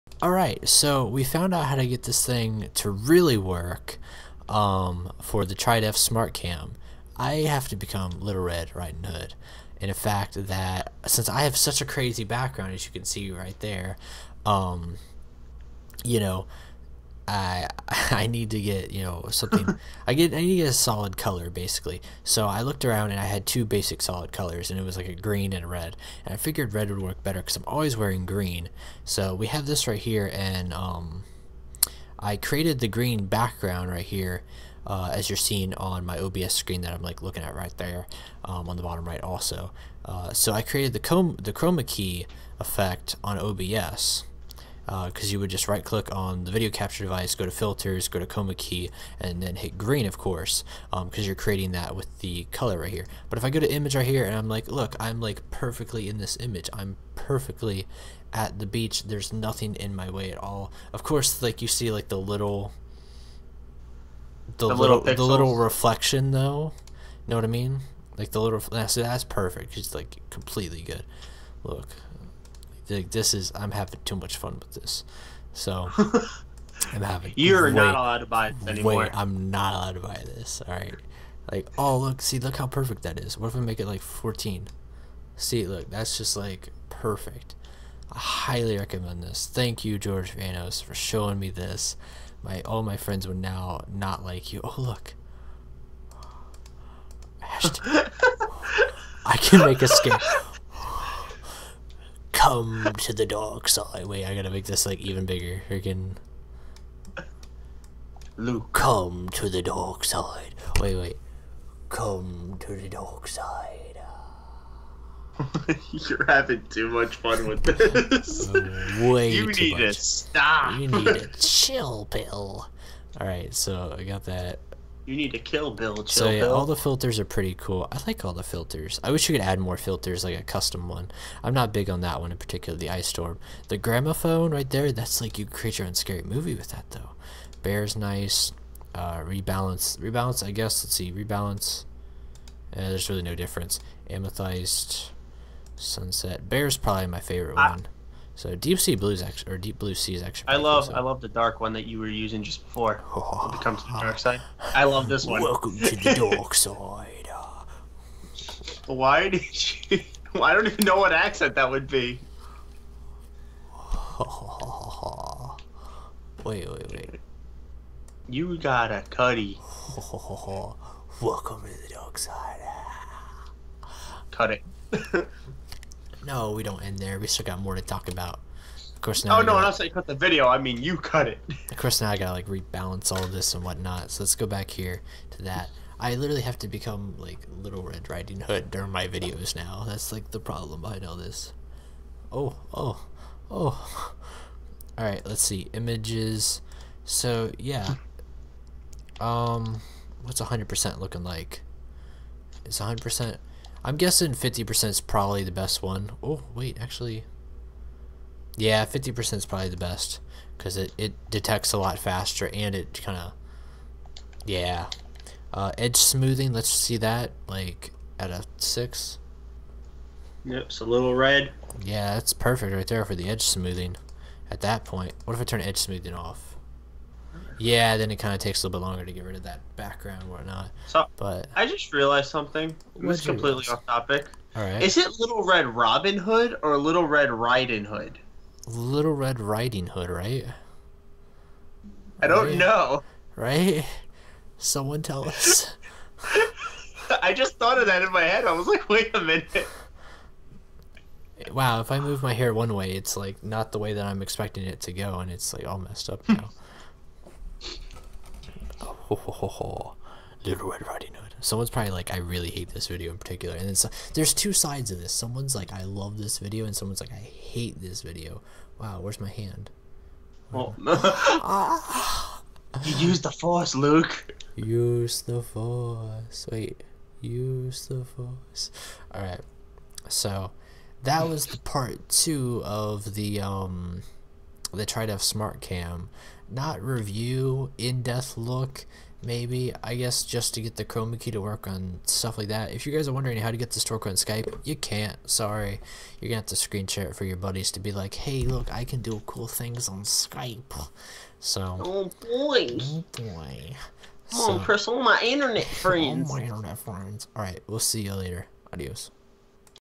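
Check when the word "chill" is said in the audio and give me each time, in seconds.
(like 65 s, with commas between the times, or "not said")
121 s, 125 s.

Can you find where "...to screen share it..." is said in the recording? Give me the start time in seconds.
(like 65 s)
296 s.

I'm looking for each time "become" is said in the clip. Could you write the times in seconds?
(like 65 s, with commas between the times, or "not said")
7 s, 186 s.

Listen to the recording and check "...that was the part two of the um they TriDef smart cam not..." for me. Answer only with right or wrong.
right.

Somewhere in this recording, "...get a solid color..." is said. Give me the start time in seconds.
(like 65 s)
20 s.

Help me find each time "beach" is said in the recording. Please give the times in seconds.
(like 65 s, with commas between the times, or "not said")
58 s.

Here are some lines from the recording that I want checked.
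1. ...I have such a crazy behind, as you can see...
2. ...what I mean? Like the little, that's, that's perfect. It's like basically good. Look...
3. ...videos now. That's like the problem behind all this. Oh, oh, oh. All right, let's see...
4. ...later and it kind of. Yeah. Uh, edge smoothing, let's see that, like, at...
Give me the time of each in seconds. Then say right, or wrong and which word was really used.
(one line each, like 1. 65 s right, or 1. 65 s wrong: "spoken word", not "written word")
1. 11 s wrong: "background", not "behind"
2. 67 s wrong: "completely", not "basically"
3. 189 s right
4. 211 s wrong: "faster", not "later".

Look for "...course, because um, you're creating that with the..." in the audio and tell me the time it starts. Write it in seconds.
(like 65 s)
50 s.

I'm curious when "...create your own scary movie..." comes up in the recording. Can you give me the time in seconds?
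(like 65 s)
135 s.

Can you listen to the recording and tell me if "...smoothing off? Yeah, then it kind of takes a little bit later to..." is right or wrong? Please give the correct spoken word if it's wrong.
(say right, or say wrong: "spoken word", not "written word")
wrong: "longer", not "later".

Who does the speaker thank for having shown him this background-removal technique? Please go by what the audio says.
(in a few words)
George Vanos.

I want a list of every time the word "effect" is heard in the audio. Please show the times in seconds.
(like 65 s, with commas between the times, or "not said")
42 s.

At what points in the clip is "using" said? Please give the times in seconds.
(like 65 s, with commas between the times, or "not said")
152 s.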